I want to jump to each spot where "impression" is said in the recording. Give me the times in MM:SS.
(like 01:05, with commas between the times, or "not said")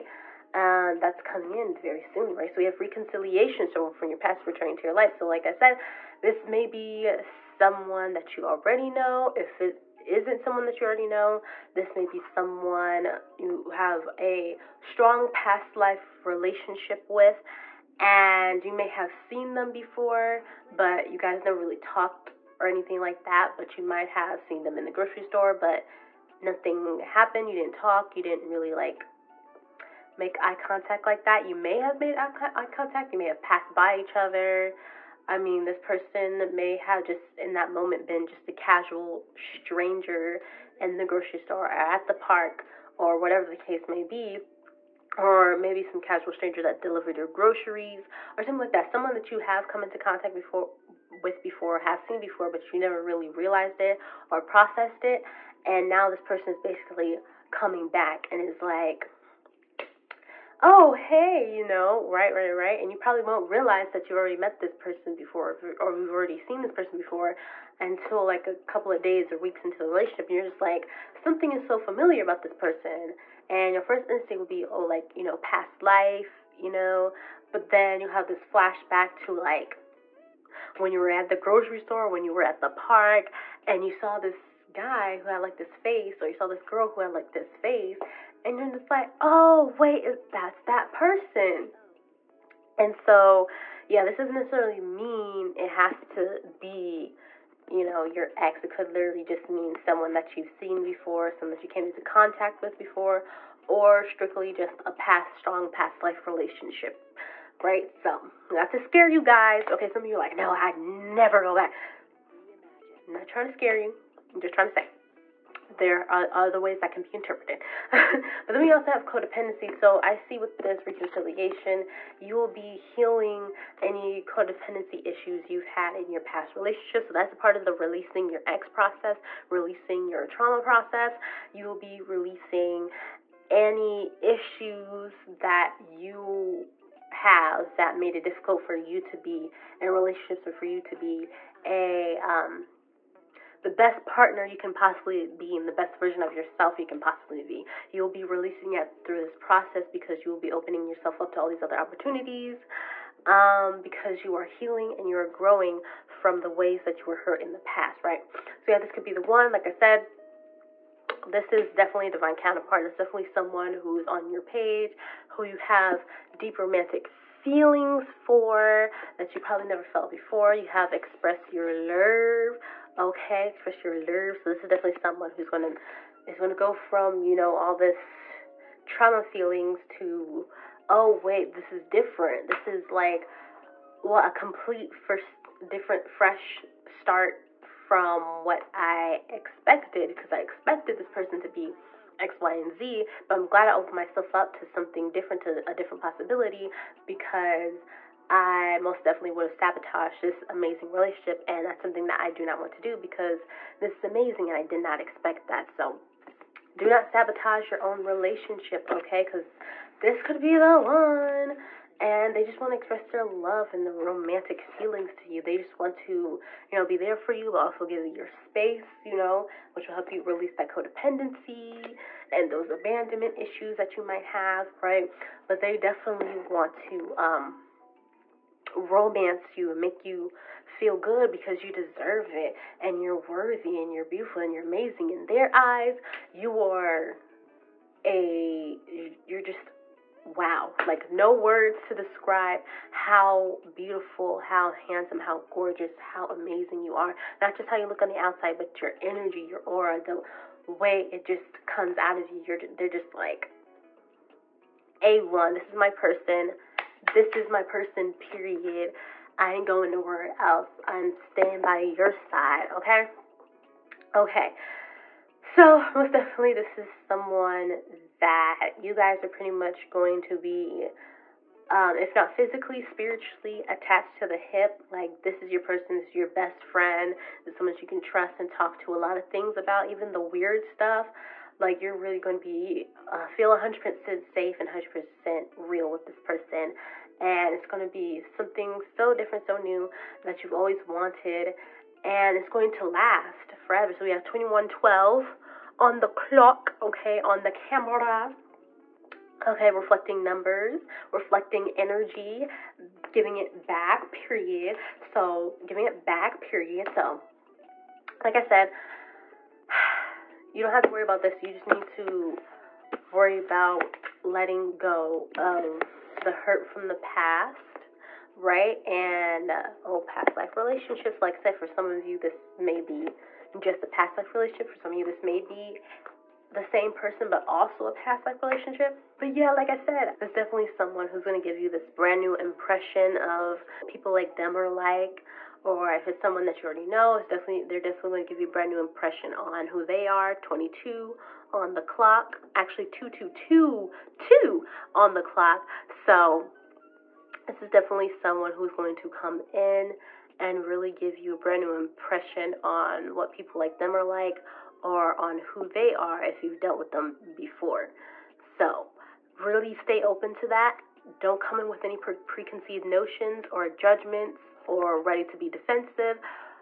05:32, 05:38, 05:51.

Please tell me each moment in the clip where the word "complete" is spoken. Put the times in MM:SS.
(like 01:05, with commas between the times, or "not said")
03:04.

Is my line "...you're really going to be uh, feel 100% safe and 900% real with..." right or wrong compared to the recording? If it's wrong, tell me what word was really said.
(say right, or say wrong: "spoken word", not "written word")
wrong: "100", not "900".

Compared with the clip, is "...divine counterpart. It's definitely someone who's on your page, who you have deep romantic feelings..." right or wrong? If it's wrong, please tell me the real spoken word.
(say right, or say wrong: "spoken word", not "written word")
right.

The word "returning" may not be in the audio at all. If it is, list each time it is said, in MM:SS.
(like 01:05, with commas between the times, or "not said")
00:04.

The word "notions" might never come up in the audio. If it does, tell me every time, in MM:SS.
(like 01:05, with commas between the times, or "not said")
06:02.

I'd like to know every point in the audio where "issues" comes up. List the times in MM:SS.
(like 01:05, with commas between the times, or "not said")
02:05, 02:14, 03:43.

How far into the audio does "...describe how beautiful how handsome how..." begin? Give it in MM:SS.
04:01.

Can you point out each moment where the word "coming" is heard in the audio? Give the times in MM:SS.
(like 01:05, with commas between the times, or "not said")
00:01, 00:57.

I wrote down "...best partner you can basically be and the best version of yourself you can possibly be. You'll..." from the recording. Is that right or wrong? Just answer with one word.
wrong.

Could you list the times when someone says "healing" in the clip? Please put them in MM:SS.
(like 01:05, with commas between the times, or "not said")
02:02, 02:34.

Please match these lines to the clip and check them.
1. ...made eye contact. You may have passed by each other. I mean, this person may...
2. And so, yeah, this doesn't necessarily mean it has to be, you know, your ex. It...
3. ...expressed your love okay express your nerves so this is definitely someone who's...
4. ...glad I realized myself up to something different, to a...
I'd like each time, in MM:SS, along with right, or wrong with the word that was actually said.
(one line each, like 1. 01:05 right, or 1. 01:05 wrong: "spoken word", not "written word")
1. 00:31 right
2. 01:32 right
3. 02:50 right
4. 03:13 wrong: "opened", not "realized".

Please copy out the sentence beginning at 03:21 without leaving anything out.
And that's something that I do not want to do because this is amazing and I did not expect that.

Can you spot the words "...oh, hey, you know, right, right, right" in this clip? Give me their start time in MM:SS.
01:00.